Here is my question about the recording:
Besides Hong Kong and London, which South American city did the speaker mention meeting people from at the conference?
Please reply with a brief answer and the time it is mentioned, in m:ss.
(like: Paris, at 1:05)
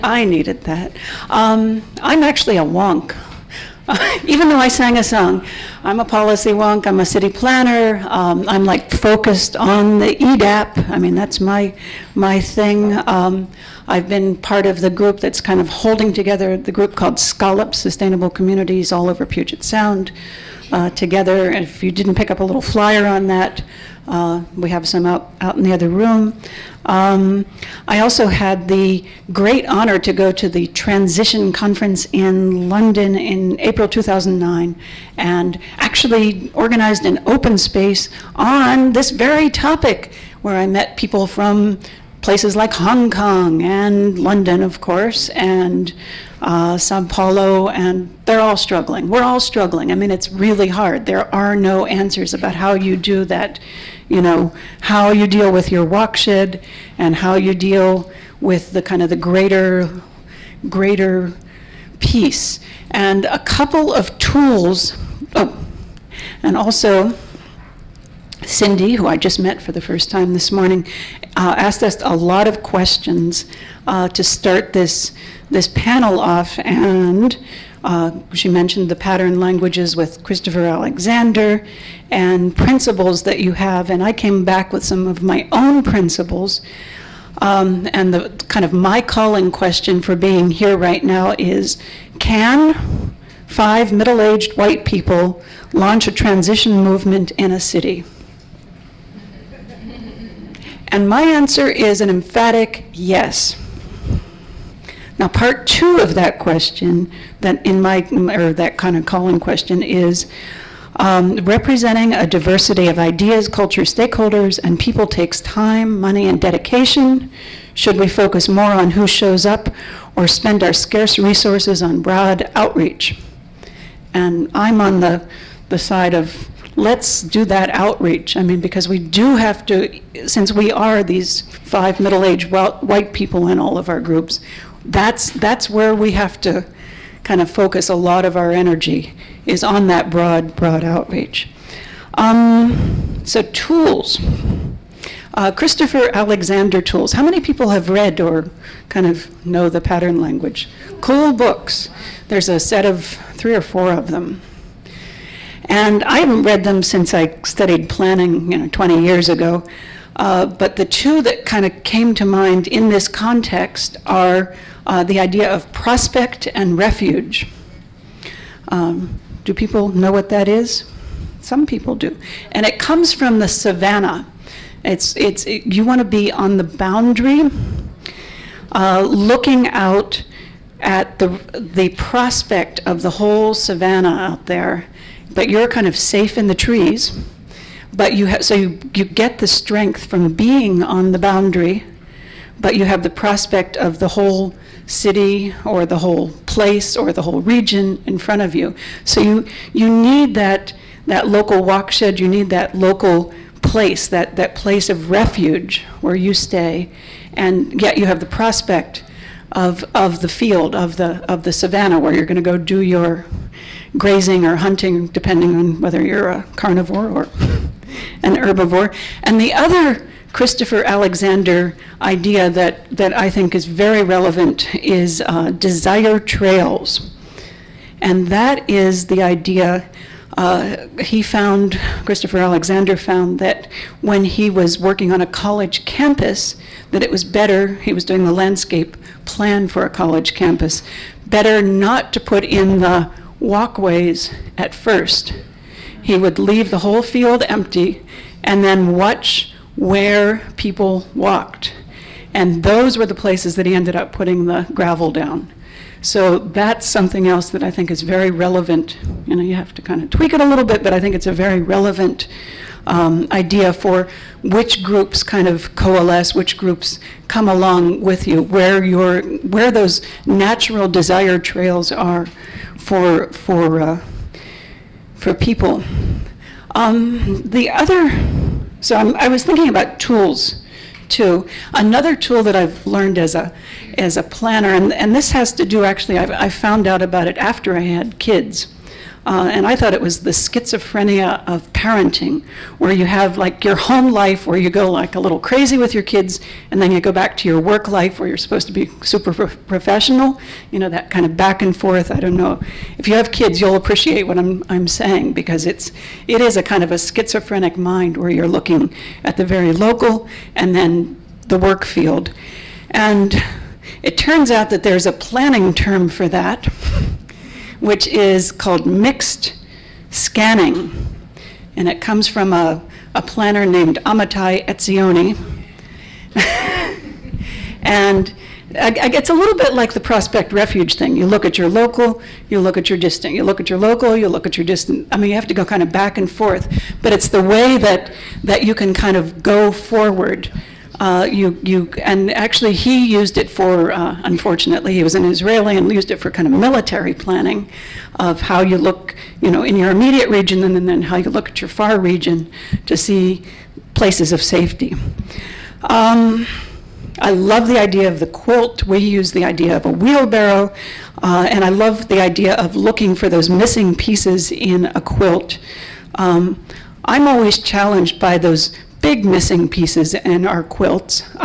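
Sao Paulo, at 0:46.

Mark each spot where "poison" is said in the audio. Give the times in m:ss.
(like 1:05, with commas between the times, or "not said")
not said.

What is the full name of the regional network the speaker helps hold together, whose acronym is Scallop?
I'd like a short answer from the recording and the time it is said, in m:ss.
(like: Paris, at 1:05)
Sustainable Communities All Over Puget Sound, at 0:17.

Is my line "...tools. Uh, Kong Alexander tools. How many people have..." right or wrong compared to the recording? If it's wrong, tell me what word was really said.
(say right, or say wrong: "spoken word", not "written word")
wrong: "Christopher", not "Kong".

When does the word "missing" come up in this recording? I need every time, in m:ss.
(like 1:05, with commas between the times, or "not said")
6:03, 6:09.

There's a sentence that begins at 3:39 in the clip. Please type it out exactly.
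And the other Christopher Alexander idea that, that I think is very relevant is uh, desire trails.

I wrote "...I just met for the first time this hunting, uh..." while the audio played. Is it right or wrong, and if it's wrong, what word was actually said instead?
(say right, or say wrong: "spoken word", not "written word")
wrong: "morning", not "hunting".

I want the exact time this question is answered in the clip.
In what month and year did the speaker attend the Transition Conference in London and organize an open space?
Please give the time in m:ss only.
0:33.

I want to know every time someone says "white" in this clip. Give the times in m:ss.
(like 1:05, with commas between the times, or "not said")
1:34, 2:12.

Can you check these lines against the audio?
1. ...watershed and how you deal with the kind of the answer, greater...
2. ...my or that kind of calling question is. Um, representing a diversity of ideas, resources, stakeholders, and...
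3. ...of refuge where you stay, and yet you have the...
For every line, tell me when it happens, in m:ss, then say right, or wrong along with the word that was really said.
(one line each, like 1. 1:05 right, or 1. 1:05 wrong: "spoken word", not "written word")
1. 0:55 wrong: "greater", not "answer"
2. 1:47 wrong: "cultures", not "resources"
3. 3:24 right.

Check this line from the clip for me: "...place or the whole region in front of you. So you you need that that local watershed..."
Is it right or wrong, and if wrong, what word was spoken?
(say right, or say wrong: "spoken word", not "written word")
right.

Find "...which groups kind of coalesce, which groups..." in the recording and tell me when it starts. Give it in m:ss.
4:24.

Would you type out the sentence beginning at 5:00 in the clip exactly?
You know, that kind of back and forth.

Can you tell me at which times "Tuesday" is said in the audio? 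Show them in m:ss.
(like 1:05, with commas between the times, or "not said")
not said.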